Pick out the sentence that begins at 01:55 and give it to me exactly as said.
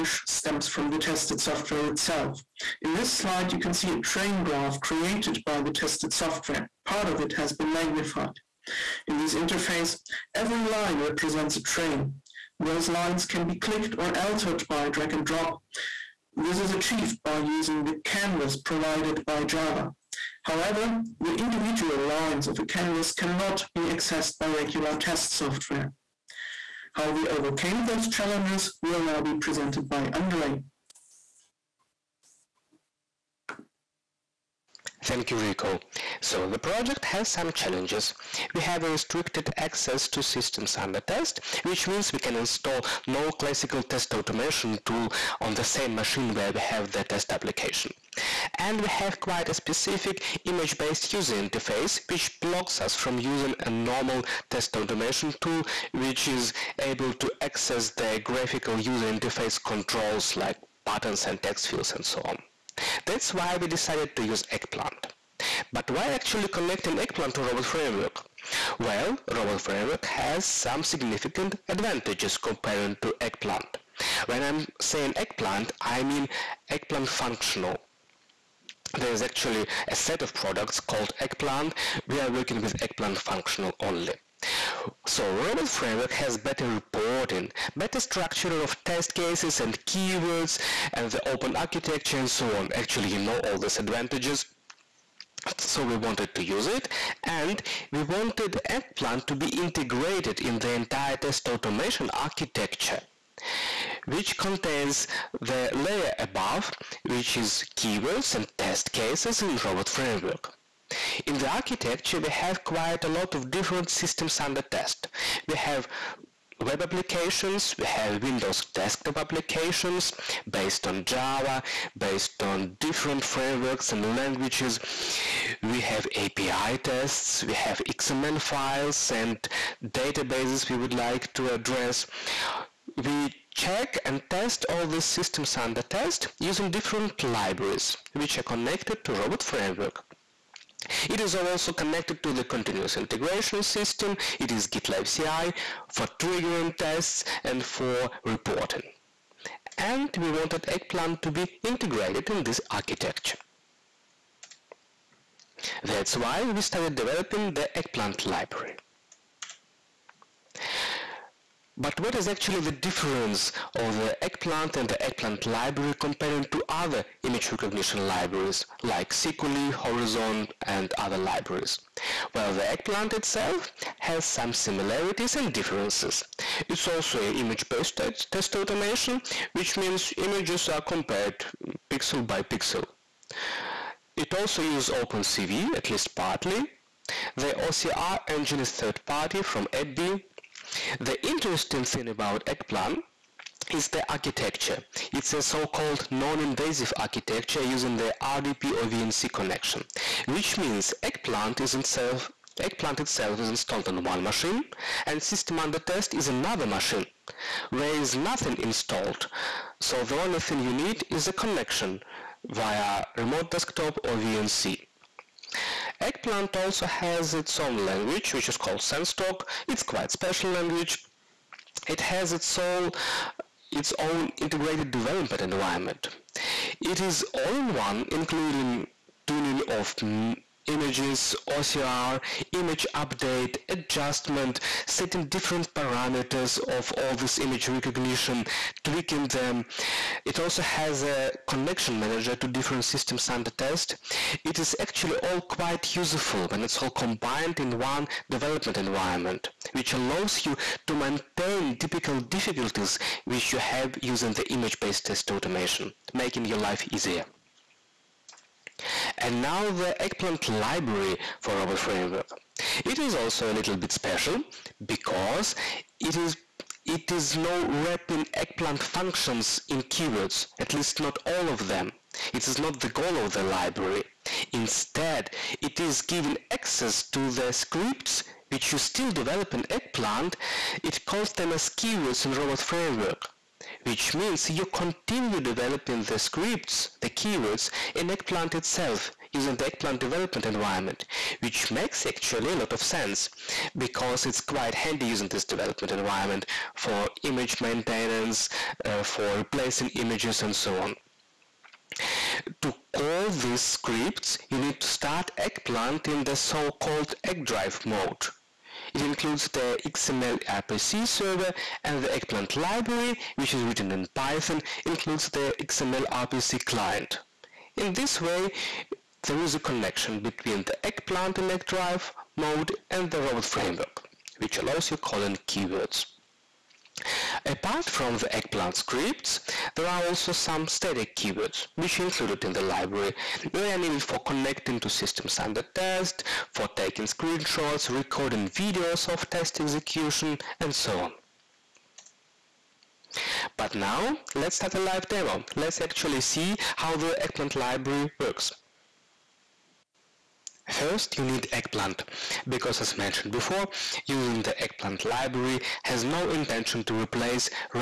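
We have web applications, we have Windows desktop applications based on Java, based on different frameworks and languages.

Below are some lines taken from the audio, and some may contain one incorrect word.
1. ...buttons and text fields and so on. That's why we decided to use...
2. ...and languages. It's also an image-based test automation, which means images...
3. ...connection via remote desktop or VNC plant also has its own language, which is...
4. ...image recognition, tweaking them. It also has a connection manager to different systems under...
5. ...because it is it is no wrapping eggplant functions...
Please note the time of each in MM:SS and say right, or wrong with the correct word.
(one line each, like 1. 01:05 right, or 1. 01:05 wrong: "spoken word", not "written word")
1. 01:00 right
2. 02:55 wrong: "differences", not "languages"
3. 03:31 right
4. 03:57 right
5. 04:24 right.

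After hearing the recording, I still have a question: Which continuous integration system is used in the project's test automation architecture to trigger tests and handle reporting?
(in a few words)
GitLab CI.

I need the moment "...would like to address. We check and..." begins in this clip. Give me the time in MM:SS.
02:10.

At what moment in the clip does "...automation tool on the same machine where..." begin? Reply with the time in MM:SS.
00:44.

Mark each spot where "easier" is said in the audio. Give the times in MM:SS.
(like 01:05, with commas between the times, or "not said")
04:16.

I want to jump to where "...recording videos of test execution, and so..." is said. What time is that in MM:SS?
05:37.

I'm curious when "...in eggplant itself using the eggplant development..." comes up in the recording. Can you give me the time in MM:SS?
04:47.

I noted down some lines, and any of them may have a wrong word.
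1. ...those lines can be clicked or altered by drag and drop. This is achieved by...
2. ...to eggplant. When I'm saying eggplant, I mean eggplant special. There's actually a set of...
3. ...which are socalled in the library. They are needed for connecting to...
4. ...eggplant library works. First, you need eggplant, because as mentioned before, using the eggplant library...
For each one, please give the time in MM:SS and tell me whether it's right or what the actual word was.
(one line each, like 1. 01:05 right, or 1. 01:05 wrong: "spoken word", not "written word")
1. 00:12 right
2. 01:13 wrong: "functional", not "special"
3. 05:31 wrong: "included", not "socalled"
4. 05:47 right.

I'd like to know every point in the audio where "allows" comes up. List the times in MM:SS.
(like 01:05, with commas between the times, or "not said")
04:09, 05:24.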